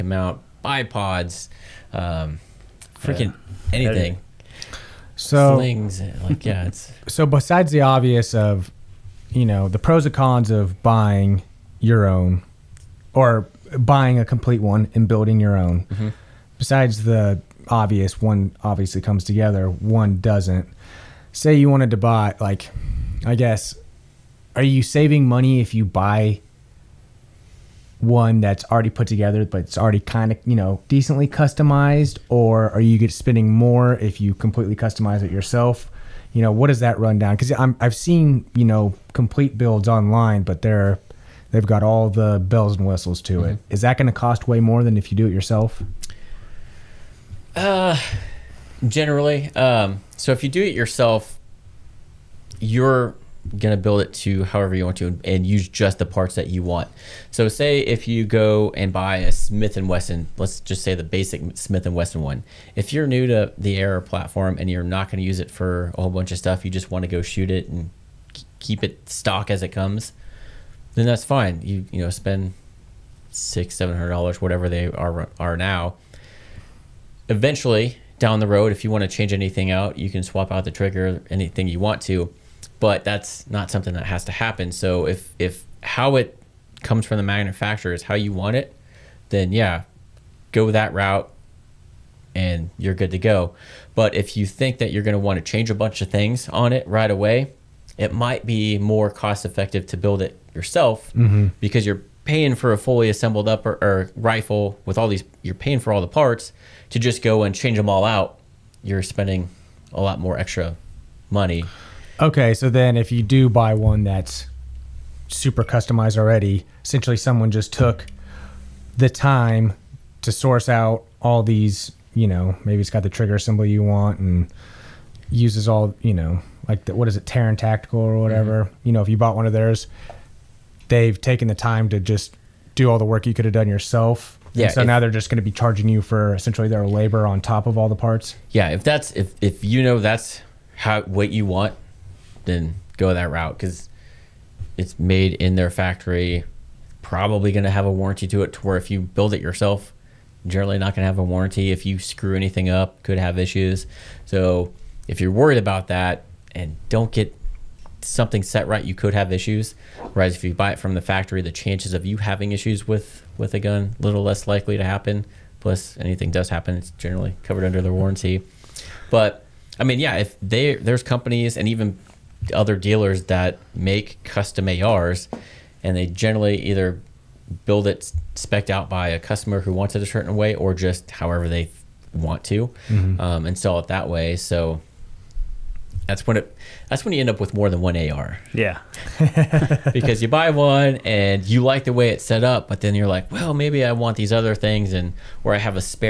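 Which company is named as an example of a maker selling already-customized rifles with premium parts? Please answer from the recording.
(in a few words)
Taran Tactical.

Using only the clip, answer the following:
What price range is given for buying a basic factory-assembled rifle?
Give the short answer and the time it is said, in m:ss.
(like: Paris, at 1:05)
$600-700, at 1:13.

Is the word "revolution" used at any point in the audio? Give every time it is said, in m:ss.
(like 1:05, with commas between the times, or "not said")
not said.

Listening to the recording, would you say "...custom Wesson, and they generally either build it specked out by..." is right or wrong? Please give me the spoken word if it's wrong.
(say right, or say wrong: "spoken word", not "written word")
wrong: "ARs", not "Wesson".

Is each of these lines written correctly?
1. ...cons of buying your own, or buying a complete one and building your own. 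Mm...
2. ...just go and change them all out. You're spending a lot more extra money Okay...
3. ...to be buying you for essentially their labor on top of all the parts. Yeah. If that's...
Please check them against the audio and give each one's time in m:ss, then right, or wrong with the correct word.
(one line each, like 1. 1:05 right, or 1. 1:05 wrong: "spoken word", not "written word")
1. 0:10 right
2. 1:46 right
3. 2:15 wrong: "charging", not "buying".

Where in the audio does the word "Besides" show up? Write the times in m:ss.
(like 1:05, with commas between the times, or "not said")
0:07, 0:16.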